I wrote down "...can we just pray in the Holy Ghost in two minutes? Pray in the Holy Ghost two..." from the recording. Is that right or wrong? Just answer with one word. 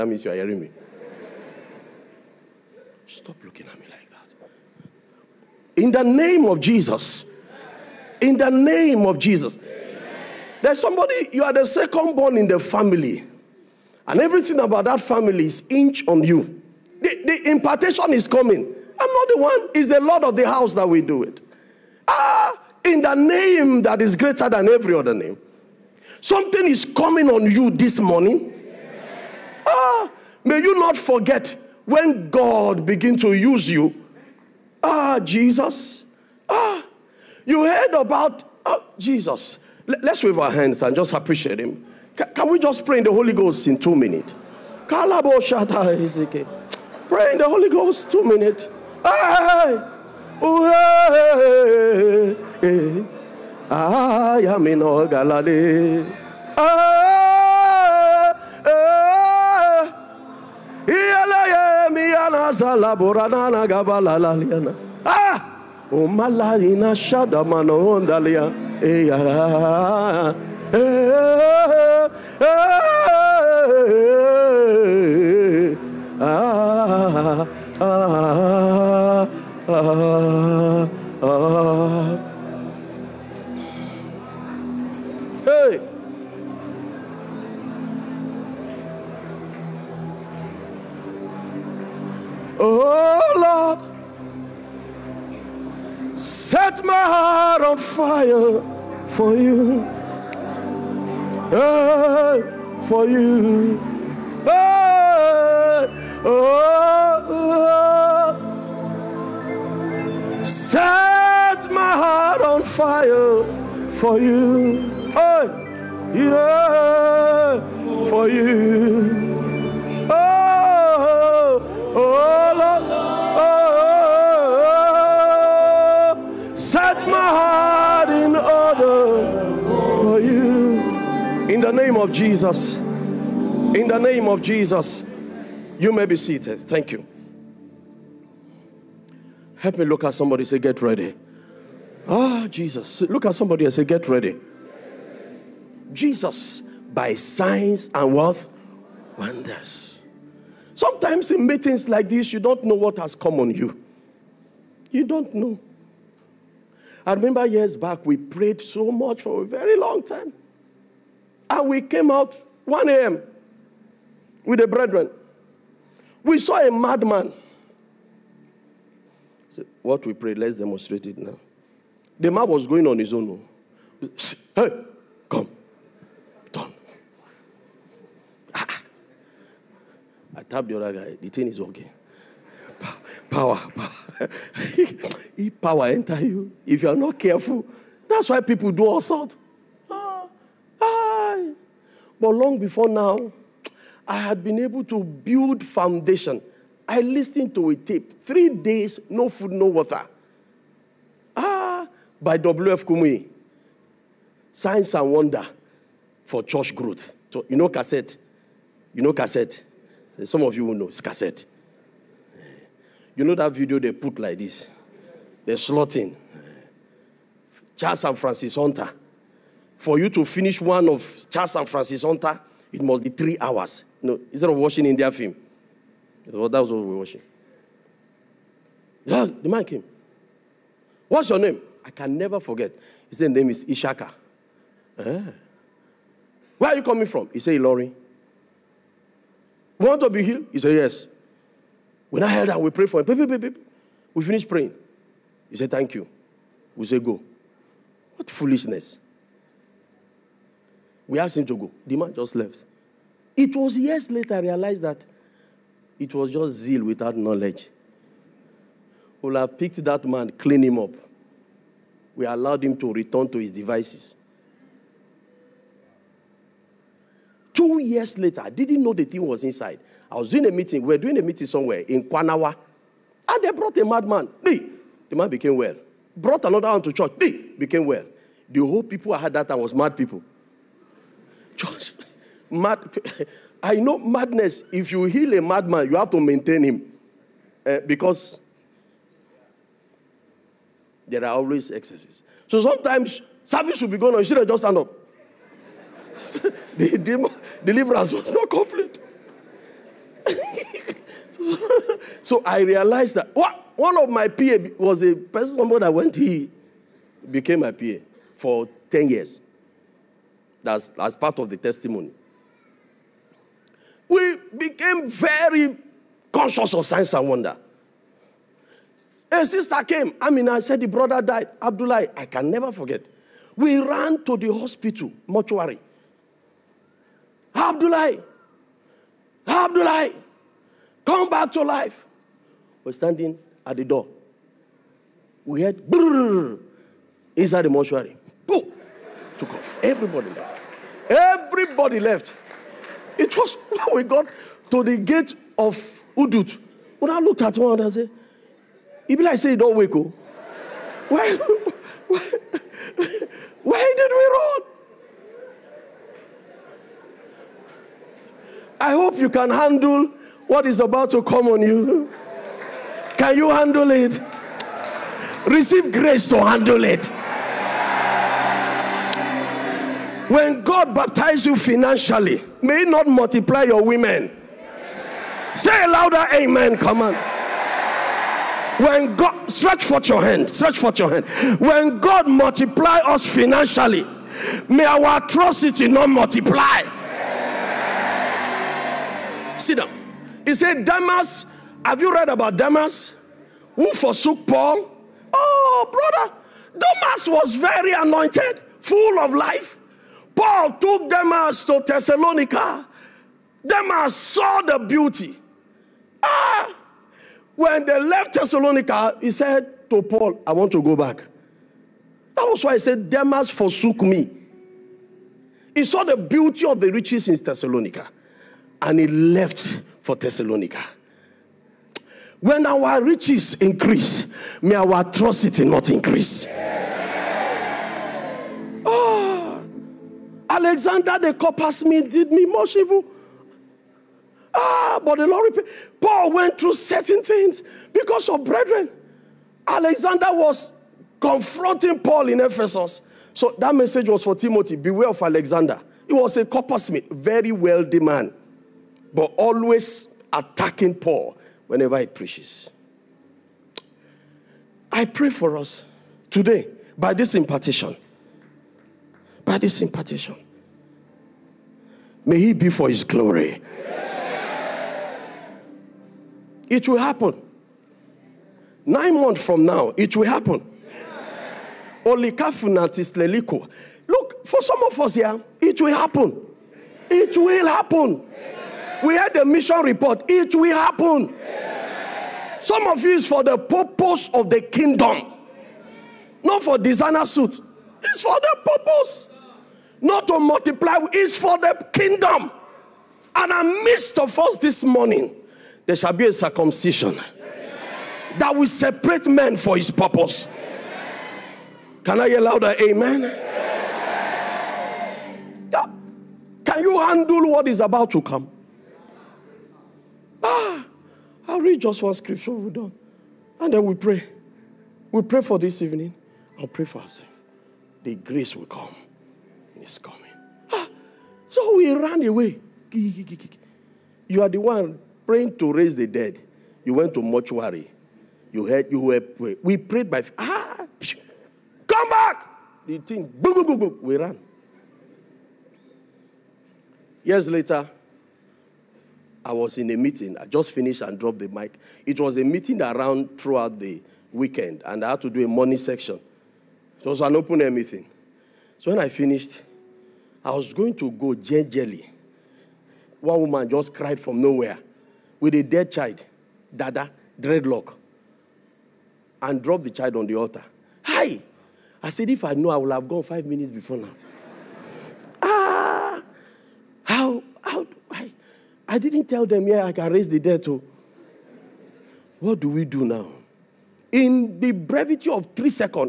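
right.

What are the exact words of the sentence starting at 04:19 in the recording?
We'll have picked that man, clean him up we allowed him to return to his devices.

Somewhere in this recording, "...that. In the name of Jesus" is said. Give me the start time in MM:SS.
00:04.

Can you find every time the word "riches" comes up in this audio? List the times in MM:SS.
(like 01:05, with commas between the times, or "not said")
06:56, 07:03.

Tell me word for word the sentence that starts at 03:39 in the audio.
For you to finish one of Charles and Frances Hunter, it must be three hours.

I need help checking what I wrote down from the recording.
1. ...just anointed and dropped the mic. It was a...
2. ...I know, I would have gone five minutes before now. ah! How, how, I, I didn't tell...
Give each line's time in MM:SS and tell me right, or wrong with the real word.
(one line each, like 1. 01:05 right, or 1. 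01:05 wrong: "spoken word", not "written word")
1. 09:00 wrong: "finished", not "anointed"
2. 09:22 right.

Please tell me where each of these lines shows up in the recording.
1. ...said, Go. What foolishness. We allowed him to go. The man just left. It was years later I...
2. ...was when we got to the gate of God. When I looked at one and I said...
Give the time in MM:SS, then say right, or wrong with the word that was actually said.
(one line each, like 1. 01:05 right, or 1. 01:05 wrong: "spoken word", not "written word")
1. 04:06 wrong: "asked", not "allowed"
2. 05:43 wrong: "Udut", not "God".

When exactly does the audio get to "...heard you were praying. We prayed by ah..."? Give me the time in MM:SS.
08:48.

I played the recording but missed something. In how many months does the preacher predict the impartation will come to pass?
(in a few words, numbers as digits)
9.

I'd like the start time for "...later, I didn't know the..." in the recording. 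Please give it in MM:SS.
04:28.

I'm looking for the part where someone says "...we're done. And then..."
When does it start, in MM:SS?
08:32.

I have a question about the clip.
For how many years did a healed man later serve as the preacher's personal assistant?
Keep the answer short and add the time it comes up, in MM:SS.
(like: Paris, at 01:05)
10, at 05:08.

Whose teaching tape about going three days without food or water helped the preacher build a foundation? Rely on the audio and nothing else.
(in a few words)
W.F. Kumuyi.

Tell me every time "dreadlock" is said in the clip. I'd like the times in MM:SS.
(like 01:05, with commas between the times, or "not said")
09:17.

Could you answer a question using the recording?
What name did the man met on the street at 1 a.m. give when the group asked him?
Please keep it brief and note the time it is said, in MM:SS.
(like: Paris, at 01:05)
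Ishaka, at 03:53.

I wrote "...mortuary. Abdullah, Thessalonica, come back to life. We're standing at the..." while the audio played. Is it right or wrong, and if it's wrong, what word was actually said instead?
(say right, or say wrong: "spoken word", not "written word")
wrong: "Abdullah", not "Thessalonica".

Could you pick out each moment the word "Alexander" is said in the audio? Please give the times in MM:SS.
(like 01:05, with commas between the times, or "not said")
07:10, 07:19, 07:25.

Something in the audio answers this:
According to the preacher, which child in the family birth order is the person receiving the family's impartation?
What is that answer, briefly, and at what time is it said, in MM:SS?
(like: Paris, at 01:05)
Second born, at 00:11.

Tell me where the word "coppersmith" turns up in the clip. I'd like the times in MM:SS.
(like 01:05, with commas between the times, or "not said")
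07:11, 07:26.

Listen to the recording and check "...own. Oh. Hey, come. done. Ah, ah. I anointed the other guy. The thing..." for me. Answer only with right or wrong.
wrong.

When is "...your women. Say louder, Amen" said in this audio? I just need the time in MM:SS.
06:13.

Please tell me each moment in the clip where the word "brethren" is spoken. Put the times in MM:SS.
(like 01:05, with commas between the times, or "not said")
02:44, 07:18.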